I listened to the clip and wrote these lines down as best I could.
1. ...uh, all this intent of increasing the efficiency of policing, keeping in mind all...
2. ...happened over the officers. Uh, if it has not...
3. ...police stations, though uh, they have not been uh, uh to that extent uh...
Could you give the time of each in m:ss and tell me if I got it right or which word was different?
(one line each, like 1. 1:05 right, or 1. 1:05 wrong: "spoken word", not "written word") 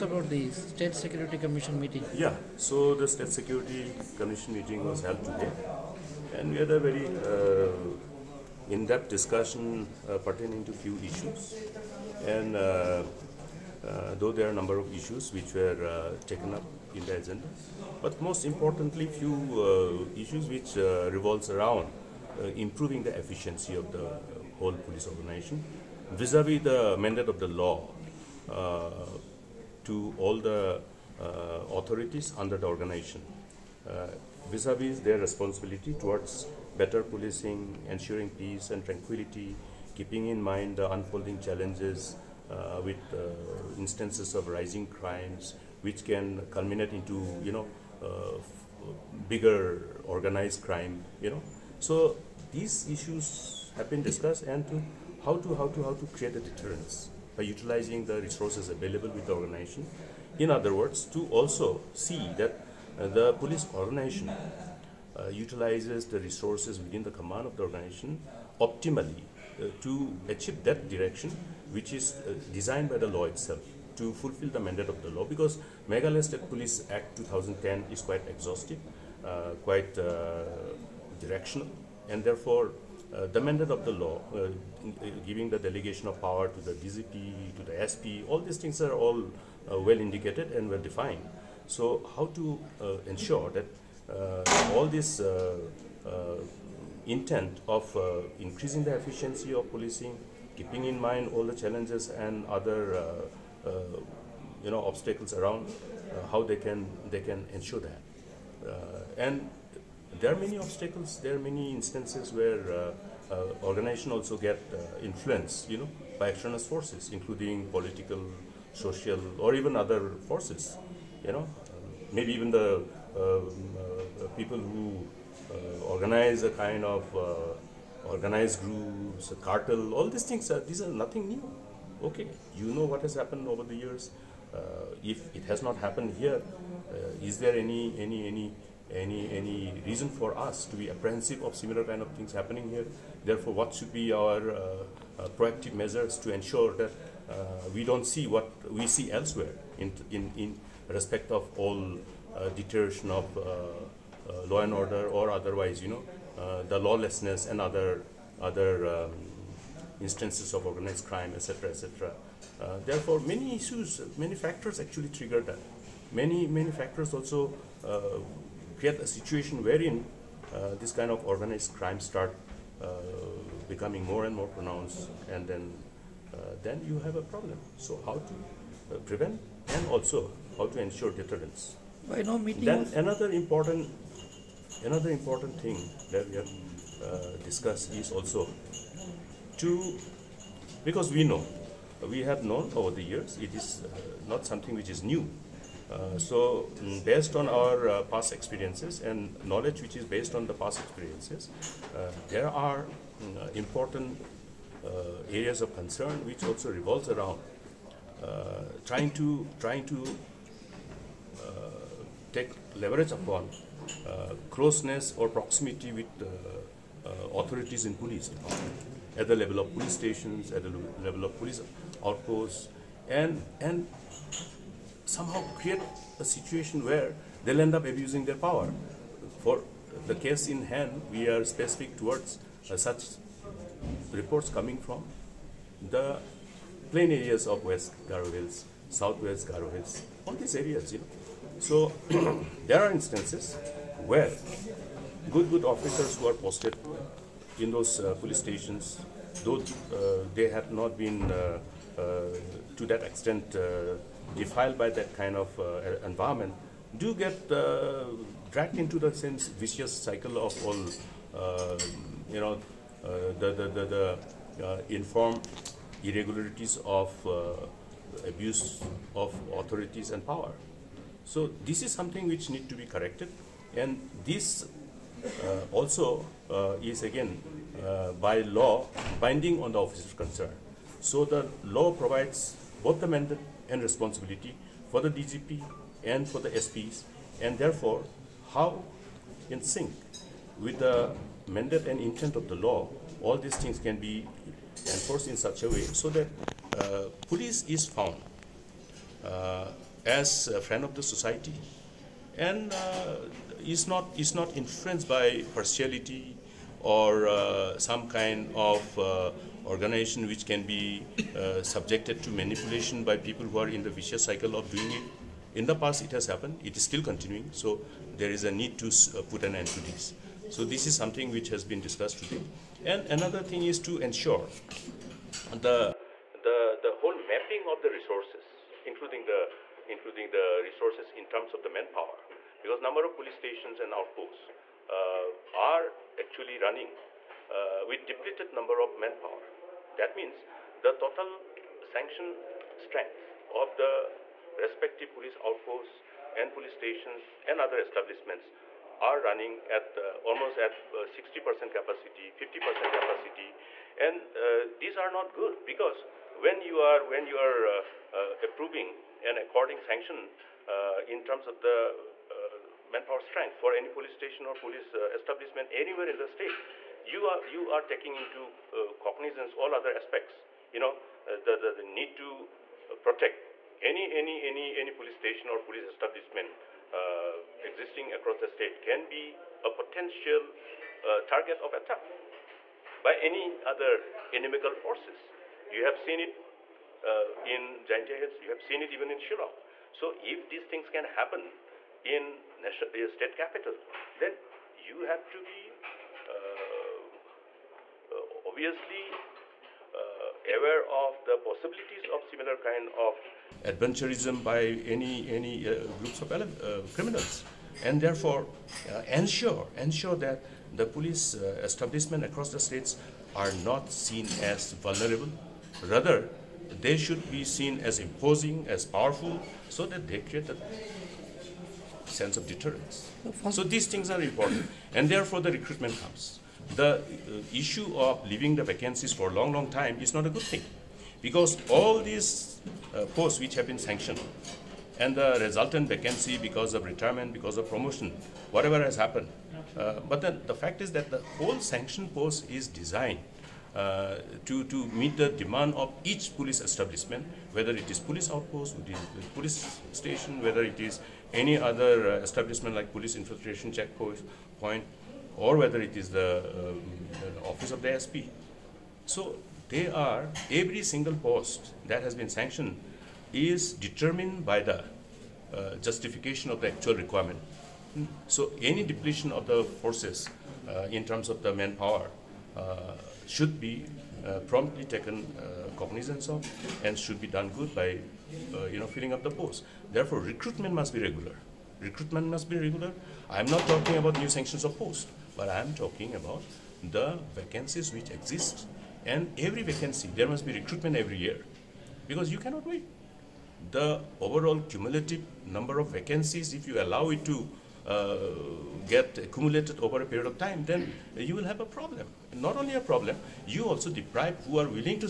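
1. 1:34 right
2. 2:13 wrong: "years", not "officers"
3. 4:08 right.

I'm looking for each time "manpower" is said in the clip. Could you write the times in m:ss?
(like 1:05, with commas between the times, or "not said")
5:31, 5:38, 6:02, 7:51.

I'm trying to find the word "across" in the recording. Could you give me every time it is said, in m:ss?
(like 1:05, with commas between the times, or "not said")
6:18, 6:52.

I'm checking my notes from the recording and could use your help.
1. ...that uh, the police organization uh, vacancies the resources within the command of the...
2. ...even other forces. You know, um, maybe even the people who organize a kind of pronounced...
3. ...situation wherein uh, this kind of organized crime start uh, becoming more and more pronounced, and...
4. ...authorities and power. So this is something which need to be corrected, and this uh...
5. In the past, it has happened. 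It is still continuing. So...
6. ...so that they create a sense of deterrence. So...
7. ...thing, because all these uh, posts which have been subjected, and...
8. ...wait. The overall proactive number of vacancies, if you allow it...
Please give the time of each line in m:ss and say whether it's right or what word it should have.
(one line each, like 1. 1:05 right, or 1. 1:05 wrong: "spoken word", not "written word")
1. 1:02 wrong: "utilizes", not "vacancies"
2. 1:59 wrong: "organized", not "pronounced"
3. 2:49 right
4. 4:29 right
5. 5:15 right
6. 6:59 right
7. 7:10 wrong: "sanctioned", not "subjected"
8. 8:12 wrong: "cumulative", not "proactive".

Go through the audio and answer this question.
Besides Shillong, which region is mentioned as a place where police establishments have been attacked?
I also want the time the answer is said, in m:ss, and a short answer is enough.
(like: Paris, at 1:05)
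Jaintia Hills, at 6:27.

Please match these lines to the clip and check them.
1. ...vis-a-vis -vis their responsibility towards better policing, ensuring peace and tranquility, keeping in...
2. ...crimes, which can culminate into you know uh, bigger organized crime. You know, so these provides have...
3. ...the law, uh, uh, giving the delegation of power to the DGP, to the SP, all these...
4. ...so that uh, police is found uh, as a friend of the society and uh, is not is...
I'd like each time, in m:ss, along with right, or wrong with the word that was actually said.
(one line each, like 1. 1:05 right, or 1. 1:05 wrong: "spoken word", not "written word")
1. 0:34 right
2. 0:44 wrong: "issues", not "provides"
3. 1:23 right
4. 4:55 right.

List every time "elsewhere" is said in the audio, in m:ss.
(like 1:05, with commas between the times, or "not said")
2:29.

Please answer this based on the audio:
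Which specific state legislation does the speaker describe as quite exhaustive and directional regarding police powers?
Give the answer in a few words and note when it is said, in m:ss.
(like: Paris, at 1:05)
Meghalaya State Police Act 2010, at 1:15.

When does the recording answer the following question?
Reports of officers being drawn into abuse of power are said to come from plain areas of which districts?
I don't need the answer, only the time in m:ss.
3:57.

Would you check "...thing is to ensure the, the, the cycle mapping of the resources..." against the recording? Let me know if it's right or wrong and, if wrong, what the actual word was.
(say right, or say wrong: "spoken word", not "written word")
wrong: "whole", not "cycle".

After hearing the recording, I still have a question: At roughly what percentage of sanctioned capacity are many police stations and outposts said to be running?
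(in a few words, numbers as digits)
60%.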